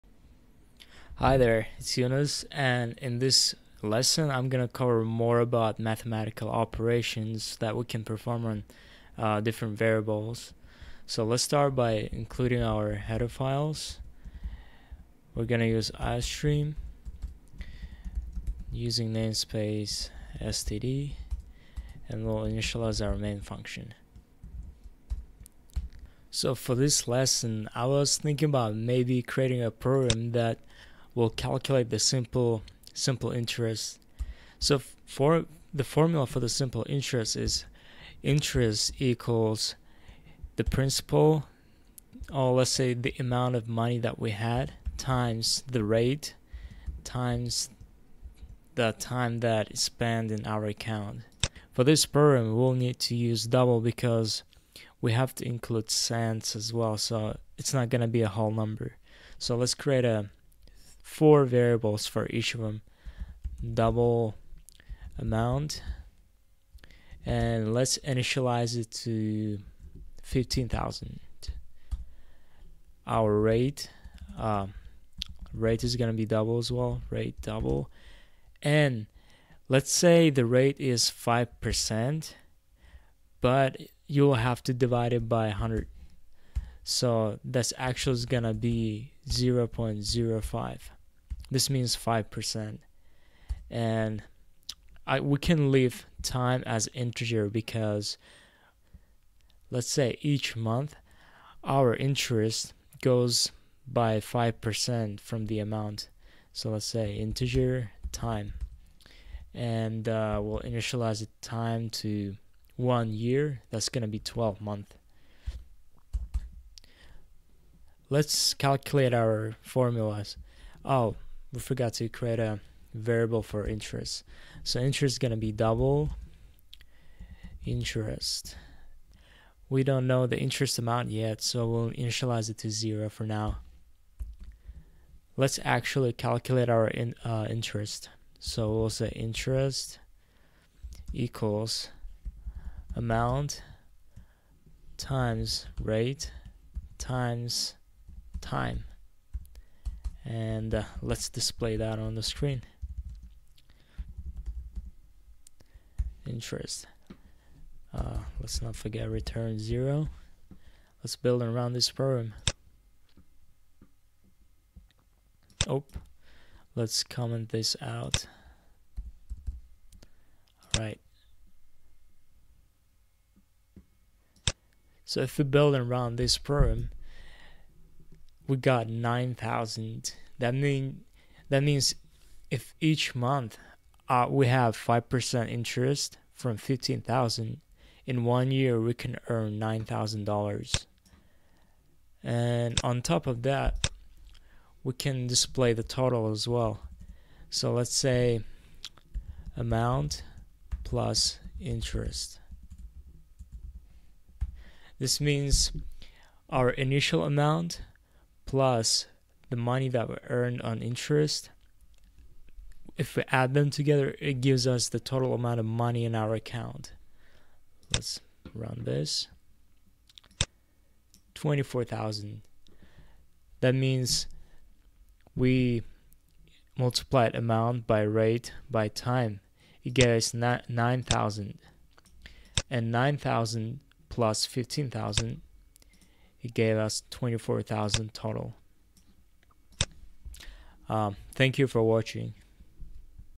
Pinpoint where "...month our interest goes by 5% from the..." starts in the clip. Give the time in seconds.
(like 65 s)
100 s.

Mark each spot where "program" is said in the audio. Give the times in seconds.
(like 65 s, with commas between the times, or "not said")
29 s, 52 s, 161 s, 176 s.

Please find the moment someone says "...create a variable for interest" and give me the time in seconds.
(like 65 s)
122 s.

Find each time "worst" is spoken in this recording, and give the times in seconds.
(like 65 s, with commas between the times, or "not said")
not said.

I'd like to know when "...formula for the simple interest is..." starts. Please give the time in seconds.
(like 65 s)
35 s.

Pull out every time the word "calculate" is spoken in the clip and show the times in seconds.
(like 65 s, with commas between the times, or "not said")
31 s, 118 s, 136 s.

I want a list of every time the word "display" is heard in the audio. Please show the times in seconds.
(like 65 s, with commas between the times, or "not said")
151 s, 195 s.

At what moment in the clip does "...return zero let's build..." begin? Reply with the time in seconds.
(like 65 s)
159 s.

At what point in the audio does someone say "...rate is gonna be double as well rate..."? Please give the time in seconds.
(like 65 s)
75 s.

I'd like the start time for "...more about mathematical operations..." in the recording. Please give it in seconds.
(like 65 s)
5 s.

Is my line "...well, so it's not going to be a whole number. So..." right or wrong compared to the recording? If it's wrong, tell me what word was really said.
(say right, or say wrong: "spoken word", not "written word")
right.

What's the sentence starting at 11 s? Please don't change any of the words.
So let's start by including our header files.